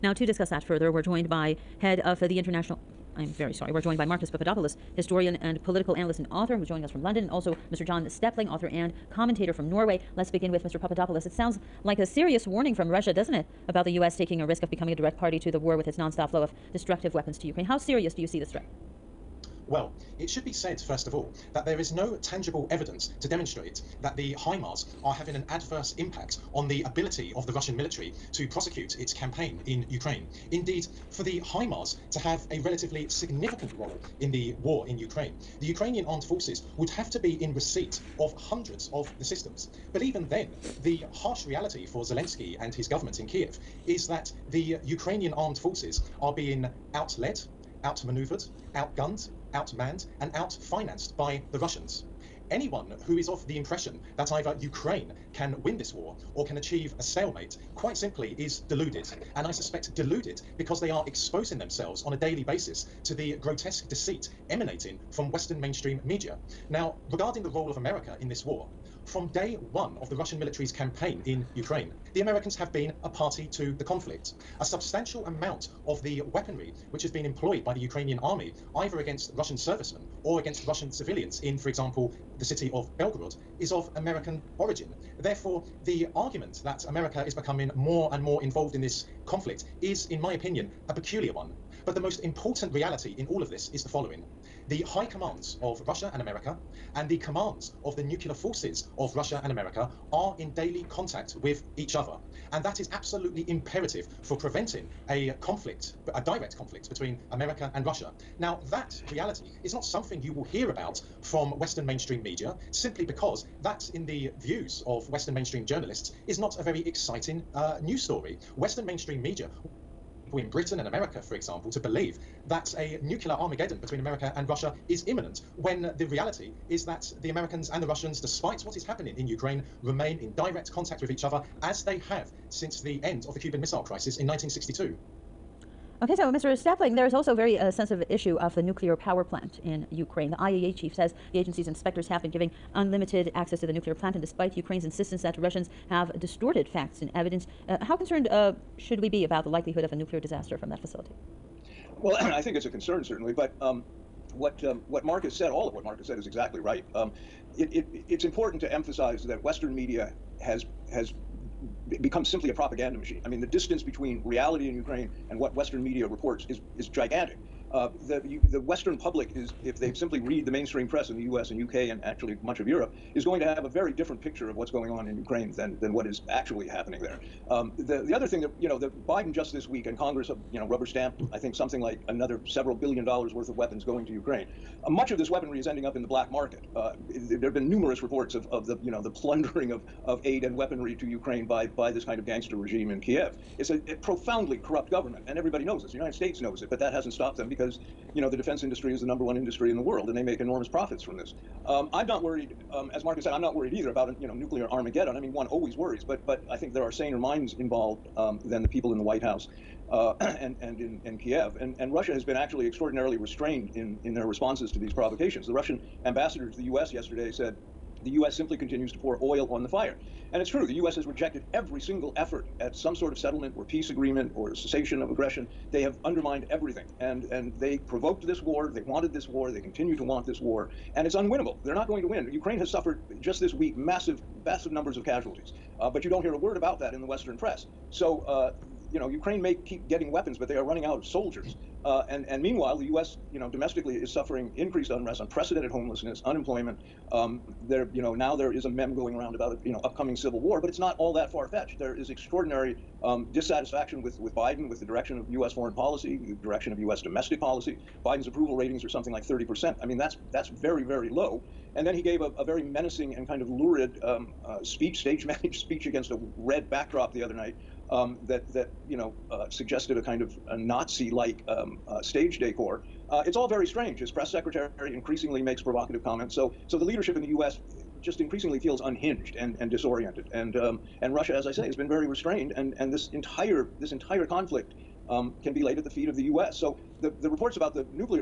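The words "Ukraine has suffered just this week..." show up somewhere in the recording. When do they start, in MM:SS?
03:52.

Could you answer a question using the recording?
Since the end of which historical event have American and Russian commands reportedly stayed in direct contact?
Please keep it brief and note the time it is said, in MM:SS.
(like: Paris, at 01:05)
Cuban Missile Crisis, at 02:13.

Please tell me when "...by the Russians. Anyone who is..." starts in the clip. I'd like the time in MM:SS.
00:51.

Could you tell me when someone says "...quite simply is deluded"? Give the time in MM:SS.
00:57.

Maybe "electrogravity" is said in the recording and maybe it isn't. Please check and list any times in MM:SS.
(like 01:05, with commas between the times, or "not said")
not said.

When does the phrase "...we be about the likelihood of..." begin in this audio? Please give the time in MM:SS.
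02:28.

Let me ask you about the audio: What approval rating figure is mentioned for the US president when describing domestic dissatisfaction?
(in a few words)
30%.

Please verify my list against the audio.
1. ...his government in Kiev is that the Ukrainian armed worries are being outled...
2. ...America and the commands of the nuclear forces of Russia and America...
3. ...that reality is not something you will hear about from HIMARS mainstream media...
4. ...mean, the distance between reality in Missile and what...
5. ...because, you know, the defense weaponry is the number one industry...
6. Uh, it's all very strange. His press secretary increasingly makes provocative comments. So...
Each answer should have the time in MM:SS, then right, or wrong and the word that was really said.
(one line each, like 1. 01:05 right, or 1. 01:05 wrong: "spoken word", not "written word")
1. 00:42 wrong: "forces", not "worries"
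2. 01:36 right
3. 01:48 wrong: "Western", not "HIMARS"
4. 02:43 wrong: "Ukraine", not "Missile"
5. 03:17 wrong: "industry", not "weaponry"
6. 04:33 right.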